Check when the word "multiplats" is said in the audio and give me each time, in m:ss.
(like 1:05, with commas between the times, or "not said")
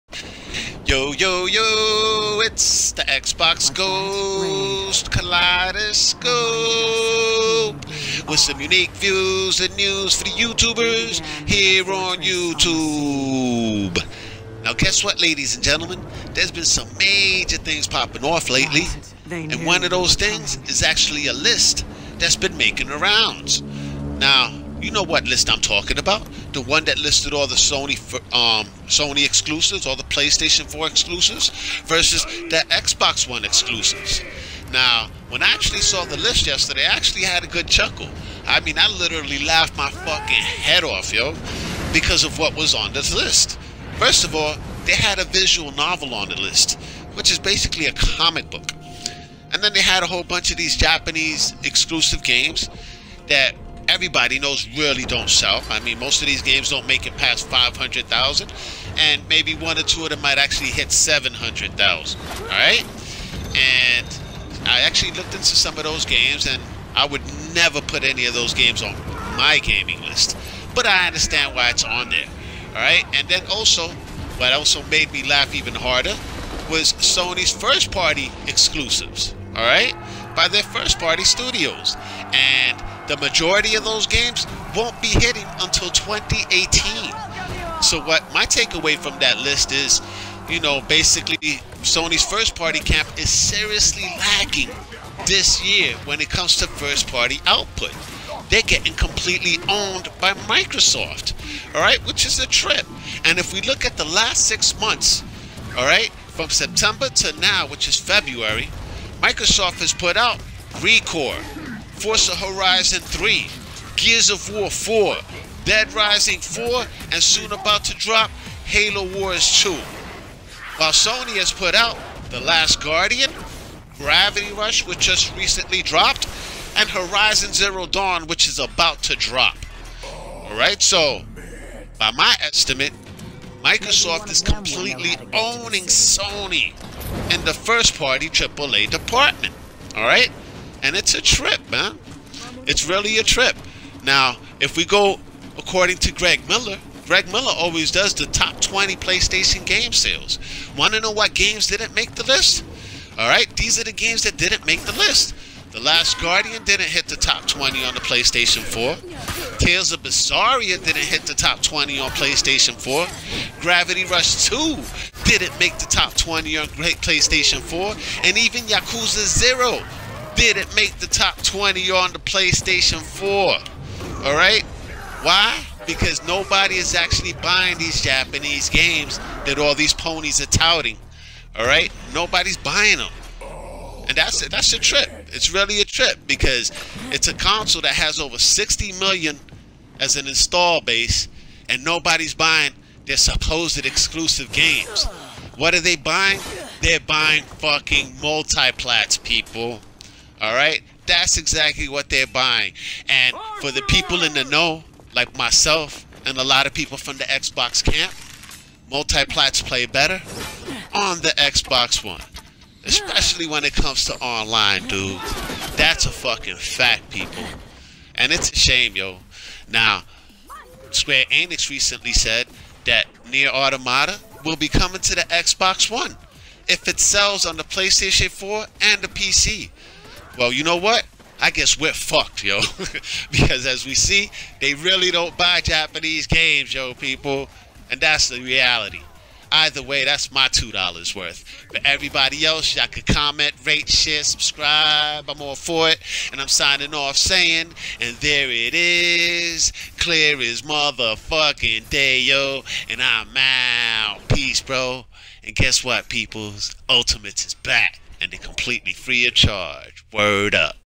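3:18, 3:28.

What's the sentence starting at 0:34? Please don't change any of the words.
Now, when I actually saw the list yesterday, I actually had a good chuckle.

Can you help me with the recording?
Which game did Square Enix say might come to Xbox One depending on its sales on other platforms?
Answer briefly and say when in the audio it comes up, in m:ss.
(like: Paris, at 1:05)
NieR Automata, at 3:43.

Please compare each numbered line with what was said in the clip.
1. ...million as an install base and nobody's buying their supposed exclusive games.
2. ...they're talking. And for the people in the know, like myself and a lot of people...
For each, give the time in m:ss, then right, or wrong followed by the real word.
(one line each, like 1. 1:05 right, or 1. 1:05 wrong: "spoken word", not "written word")
1. 3:08 right
2. 3:22 wrong: "buying", not "talking".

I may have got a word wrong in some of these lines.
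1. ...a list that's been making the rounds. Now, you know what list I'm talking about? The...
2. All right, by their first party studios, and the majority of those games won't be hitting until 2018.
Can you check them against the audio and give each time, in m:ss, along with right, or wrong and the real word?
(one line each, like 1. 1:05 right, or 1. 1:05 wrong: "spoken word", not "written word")
1. 0:21 right
2. 1:19 right.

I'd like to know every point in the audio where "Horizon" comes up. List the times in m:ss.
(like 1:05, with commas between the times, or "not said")
1:52, 2:06.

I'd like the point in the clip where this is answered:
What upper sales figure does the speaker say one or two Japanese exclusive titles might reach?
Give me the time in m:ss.
1:00.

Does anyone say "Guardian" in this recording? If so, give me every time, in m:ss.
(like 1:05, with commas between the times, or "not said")
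2:02, 2:36.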